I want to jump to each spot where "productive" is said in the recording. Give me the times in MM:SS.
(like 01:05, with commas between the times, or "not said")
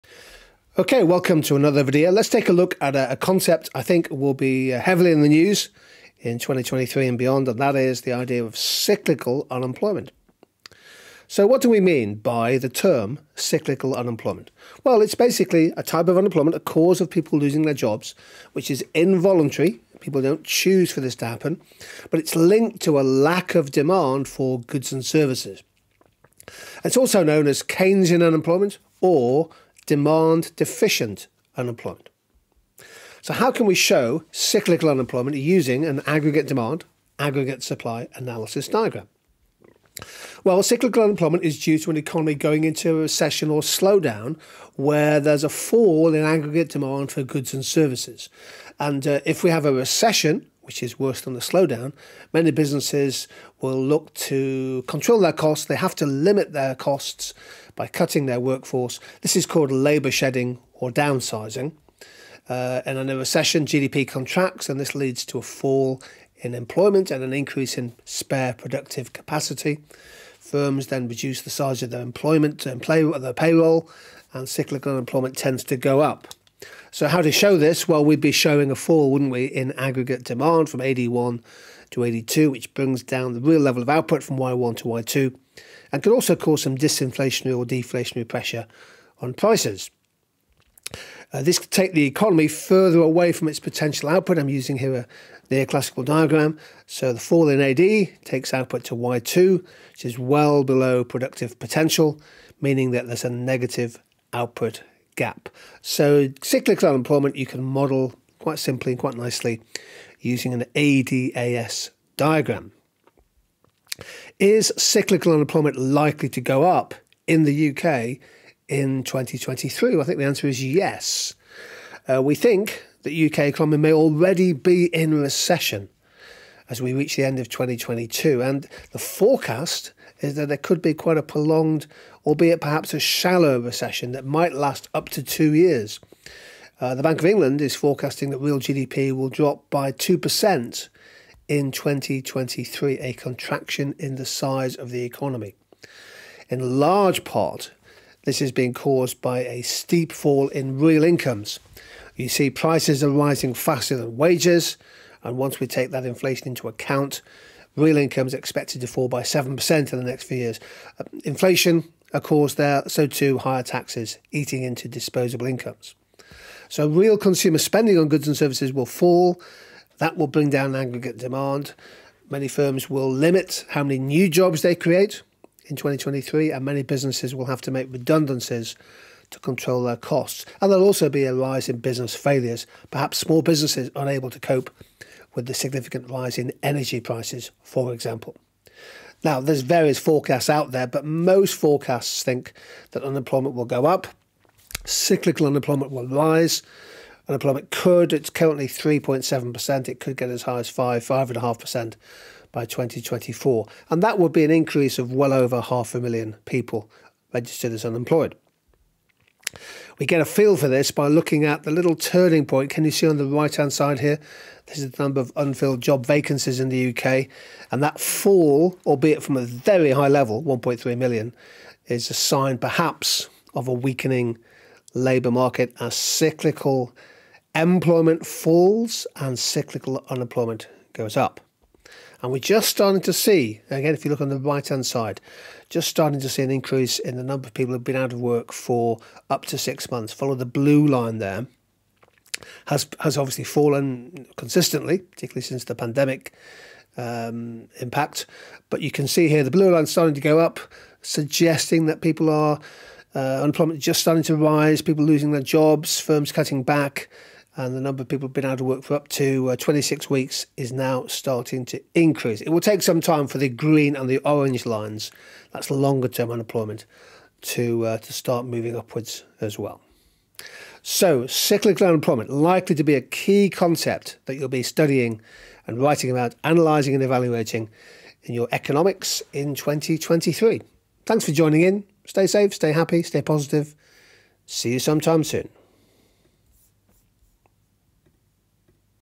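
01:08, 01:41.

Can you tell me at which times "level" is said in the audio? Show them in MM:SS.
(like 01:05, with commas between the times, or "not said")
01:23, 03:40.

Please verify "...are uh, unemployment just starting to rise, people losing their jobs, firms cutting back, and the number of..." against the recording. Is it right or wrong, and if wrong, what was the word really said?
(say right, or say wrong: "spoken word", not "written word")
right.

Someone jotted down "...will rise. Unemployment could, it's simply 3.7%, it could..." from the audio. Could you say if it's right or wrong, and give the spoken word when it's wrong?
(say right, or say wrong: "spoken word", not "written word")
wrong: "currently", not "simply".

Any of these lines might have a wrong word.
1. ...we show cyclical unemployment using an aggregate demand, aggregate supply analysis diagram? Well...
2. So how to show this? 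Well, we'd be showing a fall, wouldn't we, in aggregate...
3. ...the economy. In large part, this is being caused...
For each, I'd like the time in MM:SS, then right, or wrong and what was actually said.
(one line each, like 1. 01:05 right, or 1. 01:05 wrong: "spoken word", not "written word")
1. 00:33 right
2. 01:16 right
3. 02:24 right.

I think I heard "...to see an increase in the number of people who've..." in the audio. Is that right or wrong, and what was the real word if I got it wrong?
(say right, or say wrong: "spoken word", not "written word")
right.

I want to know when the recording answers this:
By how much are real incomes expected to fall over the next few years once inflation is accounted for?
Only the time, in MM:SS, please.
02:39.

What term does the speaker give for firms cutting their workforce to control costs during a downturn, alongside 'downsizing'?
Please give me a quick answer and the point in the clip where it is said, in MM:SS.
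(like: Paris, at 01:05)
Labour shedding, at 00:59.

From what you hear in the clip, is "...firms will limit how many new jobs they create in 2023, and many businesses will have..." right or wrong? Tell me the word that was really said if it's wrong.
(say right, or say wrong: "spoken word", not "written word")
right.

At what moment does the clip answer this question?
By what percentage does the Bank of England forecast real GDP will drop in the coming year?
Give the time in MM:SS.
02:19.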